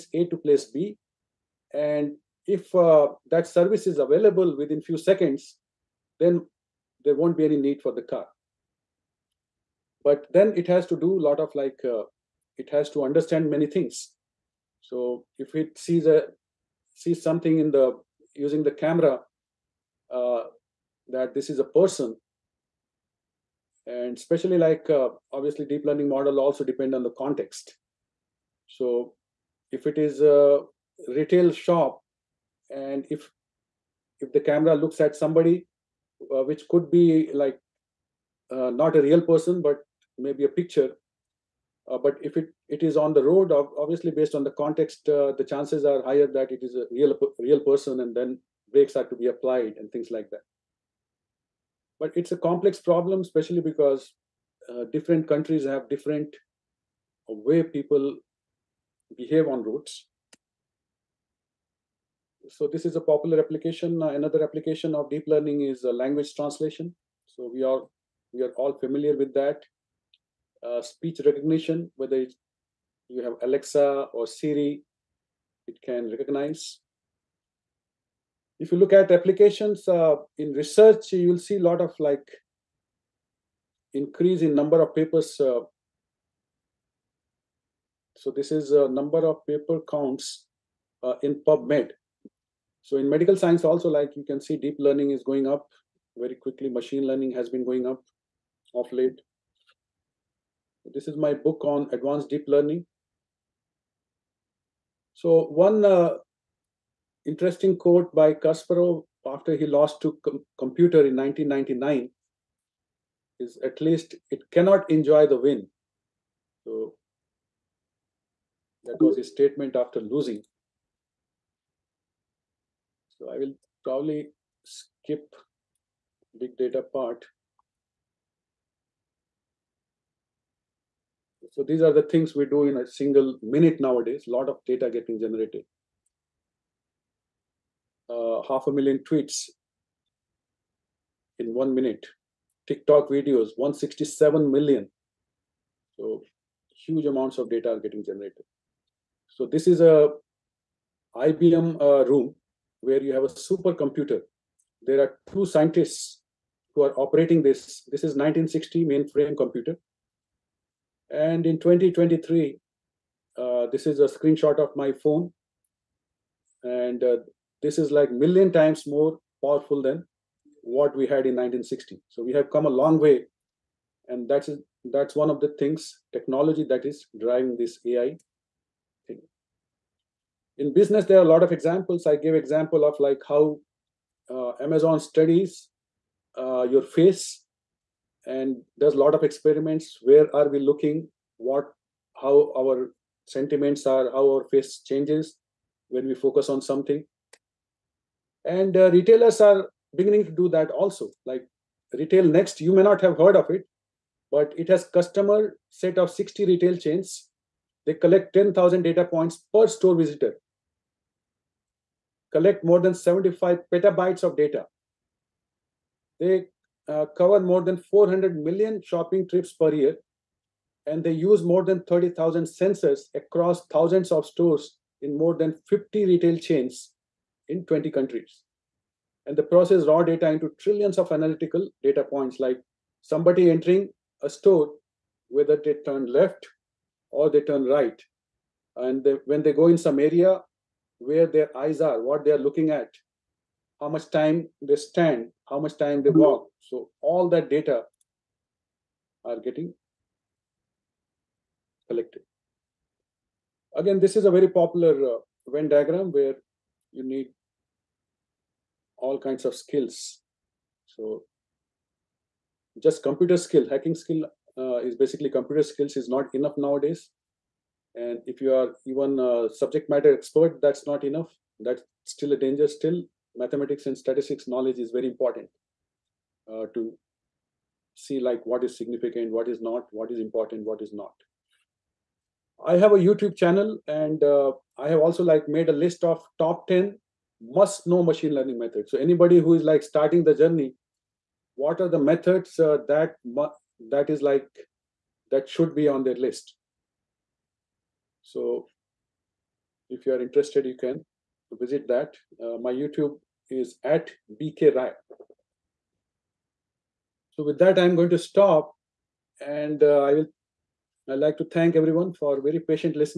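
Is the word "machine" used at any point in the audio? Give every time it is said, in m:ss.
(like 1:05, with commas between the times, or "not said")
1:36, 4:48.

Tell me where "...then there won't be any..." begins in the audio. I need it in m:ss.
0:06.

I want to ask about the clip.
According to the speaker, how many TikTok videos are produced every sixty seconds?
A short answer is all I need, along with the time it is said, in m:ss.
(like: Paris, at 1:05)
167 million, at 2:23.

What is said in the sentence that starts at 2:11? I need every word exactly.
So these are the things we do in a single minute nowadays.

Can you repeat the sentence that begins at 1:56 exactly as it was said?
So that was his statement after losing.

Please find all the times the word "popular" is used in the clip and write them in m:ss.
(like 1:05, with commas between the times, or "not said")
1:03, 4:14.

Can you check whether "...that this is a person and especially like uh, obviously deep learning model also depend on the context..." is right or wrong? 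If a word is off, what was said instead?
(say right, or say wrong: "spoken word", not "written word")
right.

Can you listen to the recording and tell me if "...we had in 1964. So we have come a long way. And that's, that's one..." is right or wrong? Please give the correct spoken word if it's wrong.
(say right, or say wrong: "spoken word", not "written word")
wrong: "1960", not "1964".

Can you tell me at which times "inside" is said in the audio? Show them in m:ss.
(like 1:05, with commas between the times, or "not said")
not said.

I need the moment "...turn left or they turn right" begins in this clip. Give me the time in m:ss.
3:55.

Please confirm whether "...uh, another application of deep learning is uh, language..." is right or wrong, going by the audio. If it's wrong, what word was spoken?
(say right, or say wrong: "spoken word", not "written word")
right.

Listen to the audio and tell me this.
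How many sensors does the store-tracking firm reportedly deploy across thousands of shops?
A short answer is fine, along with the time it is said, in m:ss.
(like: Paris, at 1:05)
30,000, at 3:41.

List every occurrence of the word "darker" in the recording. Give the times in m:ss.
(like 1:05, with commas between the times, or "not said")
not said.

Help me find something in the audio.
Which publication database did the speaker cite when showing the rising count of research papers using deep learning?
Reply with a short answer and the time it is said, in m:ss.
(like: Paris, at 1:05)
PubMed, at 1:31.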